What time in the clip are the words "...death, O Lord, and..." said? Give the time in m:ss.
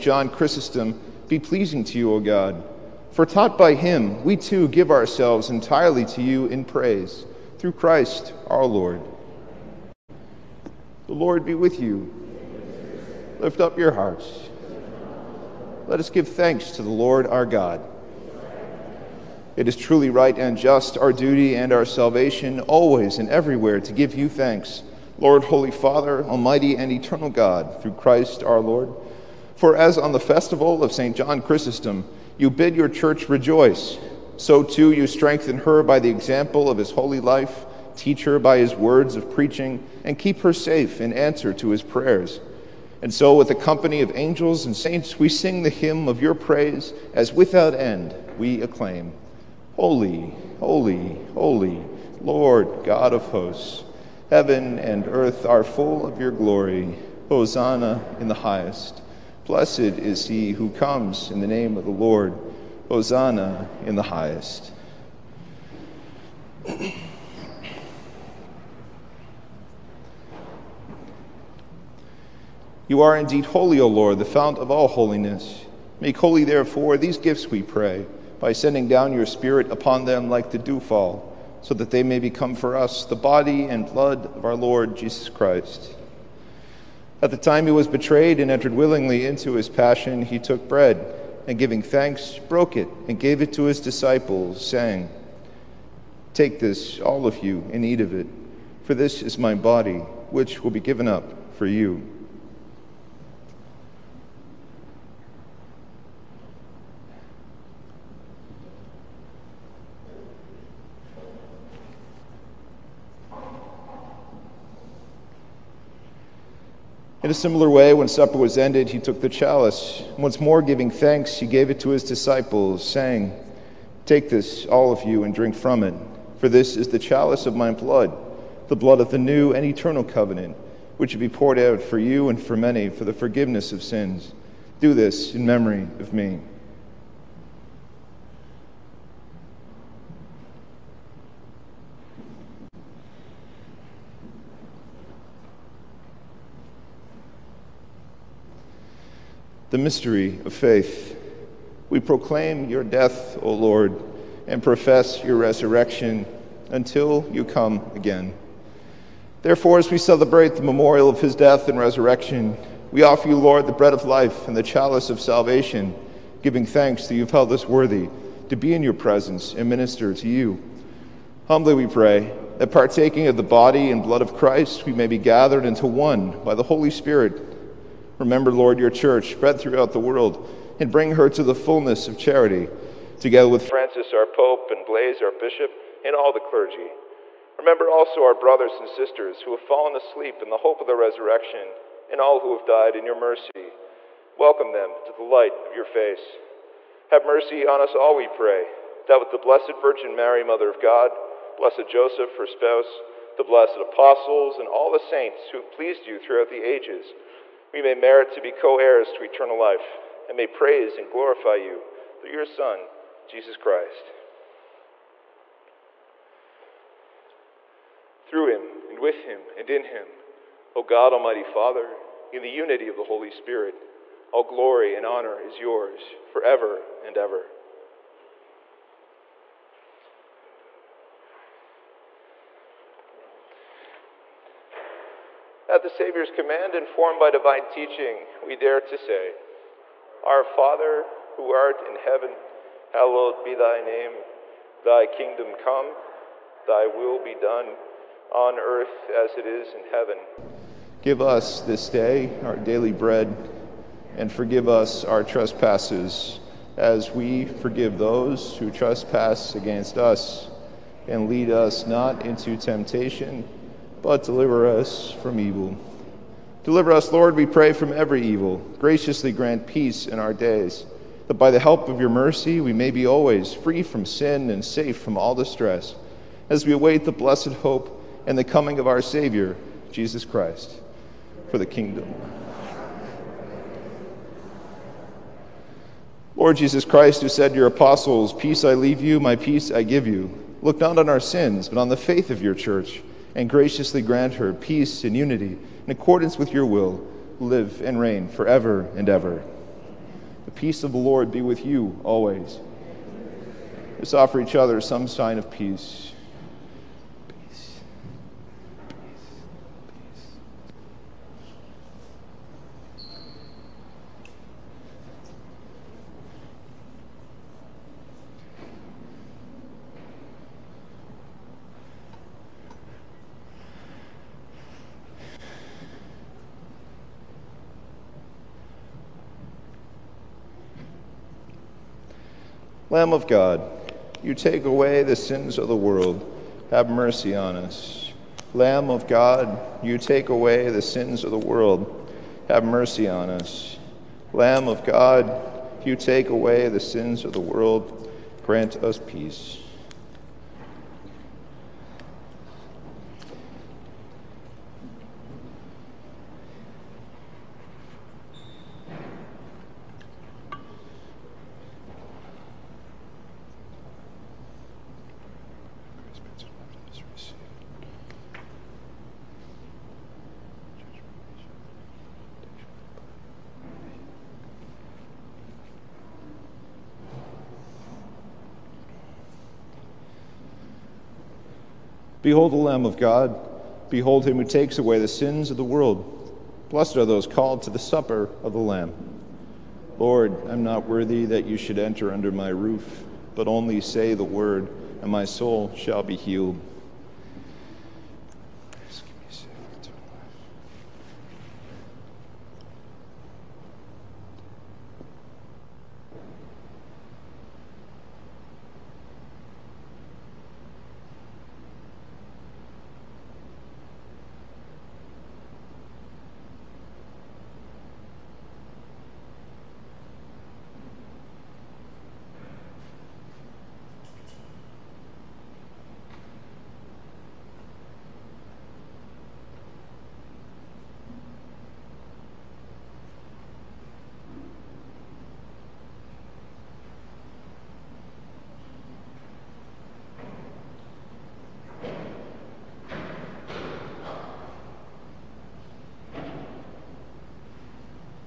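2:32.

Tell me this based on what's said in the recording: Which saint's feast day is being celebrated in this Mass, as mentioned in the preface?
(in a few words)
St. John Chrysostom.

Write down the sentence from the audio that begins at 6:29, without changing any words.
Lord, I'm not worthy that you should enter under my roof, but only say the word, and my soul shall be healed.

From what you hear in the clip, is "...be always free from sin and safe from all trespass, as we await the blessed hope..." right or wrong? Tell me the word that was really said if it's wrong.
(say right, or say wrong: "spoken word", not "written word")
wrong: "distress", not "trespass".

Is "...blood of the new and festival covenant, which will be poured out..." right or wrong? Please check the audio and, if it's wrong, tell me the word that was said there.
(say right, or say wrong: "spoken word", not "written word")
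wrong: "eternal", not "festival".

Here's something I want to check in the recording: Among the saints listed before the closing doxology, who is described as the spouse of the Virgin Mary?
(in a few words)
Blessed Joseph.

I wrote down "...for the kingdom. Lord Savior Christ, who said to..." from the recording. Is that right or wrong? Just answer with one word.
wrong.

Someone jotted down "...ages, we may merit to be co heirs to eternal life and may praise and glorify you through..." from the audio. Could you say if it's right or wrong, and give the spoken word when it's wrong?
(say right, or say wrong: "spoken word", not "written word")
right.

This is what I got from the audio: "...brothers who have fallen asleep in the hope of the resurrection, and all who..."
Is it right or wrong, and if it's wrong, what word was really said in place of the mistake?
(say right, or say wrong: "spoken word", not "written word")
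wrong: "sisters", not "brothers".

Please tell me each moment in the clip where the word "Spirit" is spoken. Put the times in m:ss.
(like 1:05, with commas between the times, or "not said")
1:19, 2:56, 3:43.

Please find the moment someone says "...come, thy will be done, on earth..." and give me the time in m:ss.
4:05.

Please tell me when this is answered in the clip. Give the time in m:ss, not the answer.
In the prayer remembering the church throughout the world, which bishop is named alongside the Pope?
3:04.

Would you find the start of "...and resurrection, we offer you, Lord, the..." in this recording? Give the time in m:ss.
2:41.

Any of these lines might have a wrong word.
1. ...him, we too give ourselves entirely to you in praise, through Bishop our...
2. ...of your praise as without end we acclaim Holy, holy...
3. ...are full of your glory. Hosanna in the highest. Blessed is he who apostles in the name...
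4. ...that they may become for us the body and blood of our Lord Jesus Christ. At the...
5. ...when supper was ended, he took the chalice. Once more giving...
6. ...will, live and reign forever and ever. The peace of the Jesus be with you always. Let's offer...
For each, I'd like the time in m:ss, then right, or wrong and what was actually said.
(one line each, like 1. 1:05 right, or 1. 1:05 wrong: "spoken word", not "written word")
1. 0:03 wrong: "Christ", not "Bishop"
2. 0:46 right
3. 0:55 wrong: "comes", not "apostles"
4. 1:21 right
5. 1:57 right
6. 4:56 wrong: "Lord", not "Jesus".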